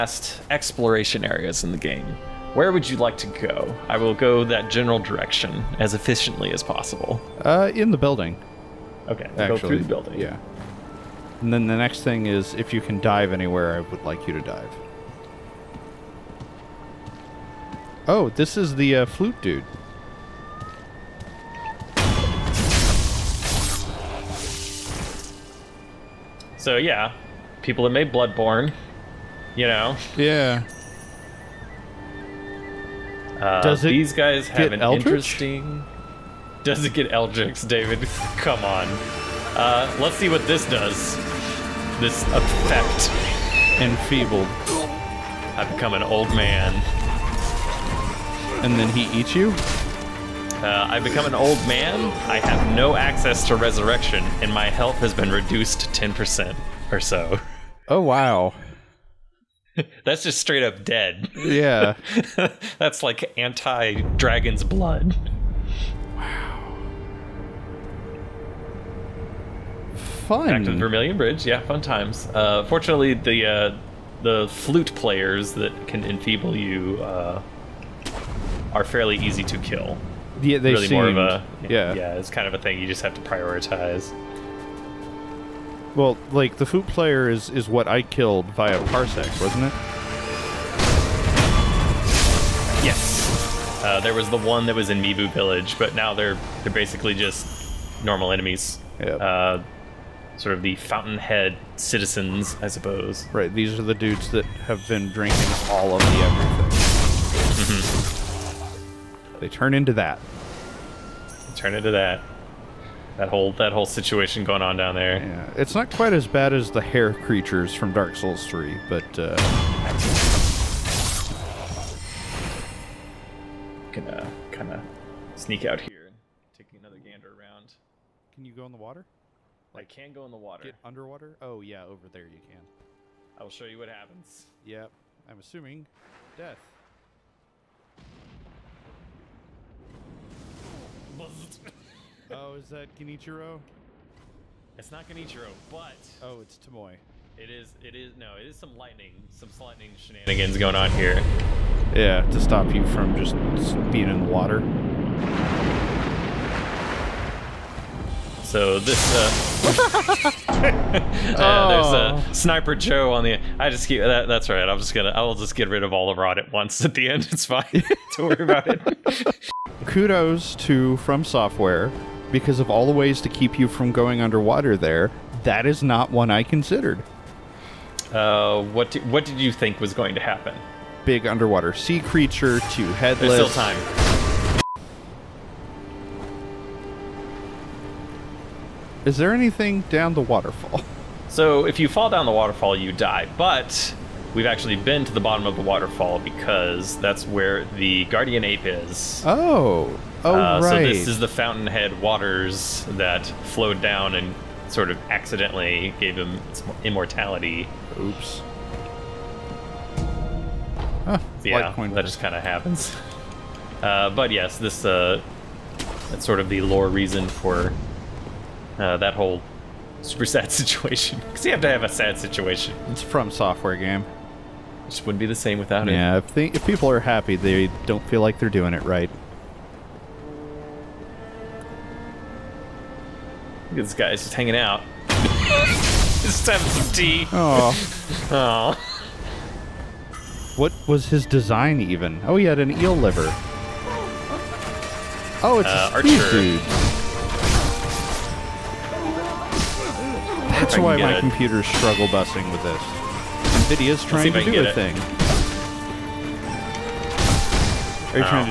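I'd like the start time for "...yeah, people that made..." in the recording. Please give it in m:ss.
0:26.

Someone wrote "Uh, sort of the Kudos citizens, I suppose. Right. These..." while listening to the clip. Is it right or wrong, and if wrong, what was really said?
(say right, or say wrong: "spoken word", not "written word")
wrong: "Fountainhead", not "Kudos".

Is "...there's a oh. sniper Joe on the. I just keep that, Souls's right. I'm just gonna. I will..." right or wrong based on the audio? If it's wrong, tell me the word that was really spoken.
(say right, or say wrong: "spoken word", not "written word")
wrong: "That", not "Souls".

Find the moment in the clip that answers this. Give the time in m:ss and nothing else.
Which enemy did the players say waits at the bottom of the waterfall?
3:18.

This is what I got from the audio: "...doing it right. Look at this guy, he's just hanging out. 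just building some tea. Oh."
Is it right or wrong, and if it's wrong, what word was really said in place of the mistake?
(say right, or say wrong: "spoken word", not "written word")
wrong: "having", not "building".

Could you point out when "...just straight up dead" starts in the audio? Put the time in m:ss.
1:00.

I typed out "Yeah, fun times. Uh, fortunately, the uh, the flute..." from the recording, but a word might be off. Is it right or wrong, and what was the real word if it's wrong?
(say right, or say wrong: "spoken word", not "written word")
right.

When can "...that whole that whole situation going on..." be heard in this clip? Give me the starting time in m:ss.
1:53.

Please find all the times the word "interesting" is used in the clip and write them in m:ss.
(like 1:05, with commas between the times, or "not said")
0:35.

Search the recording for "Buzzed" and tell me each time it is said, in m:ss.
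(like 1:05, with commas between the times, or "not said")
2:21.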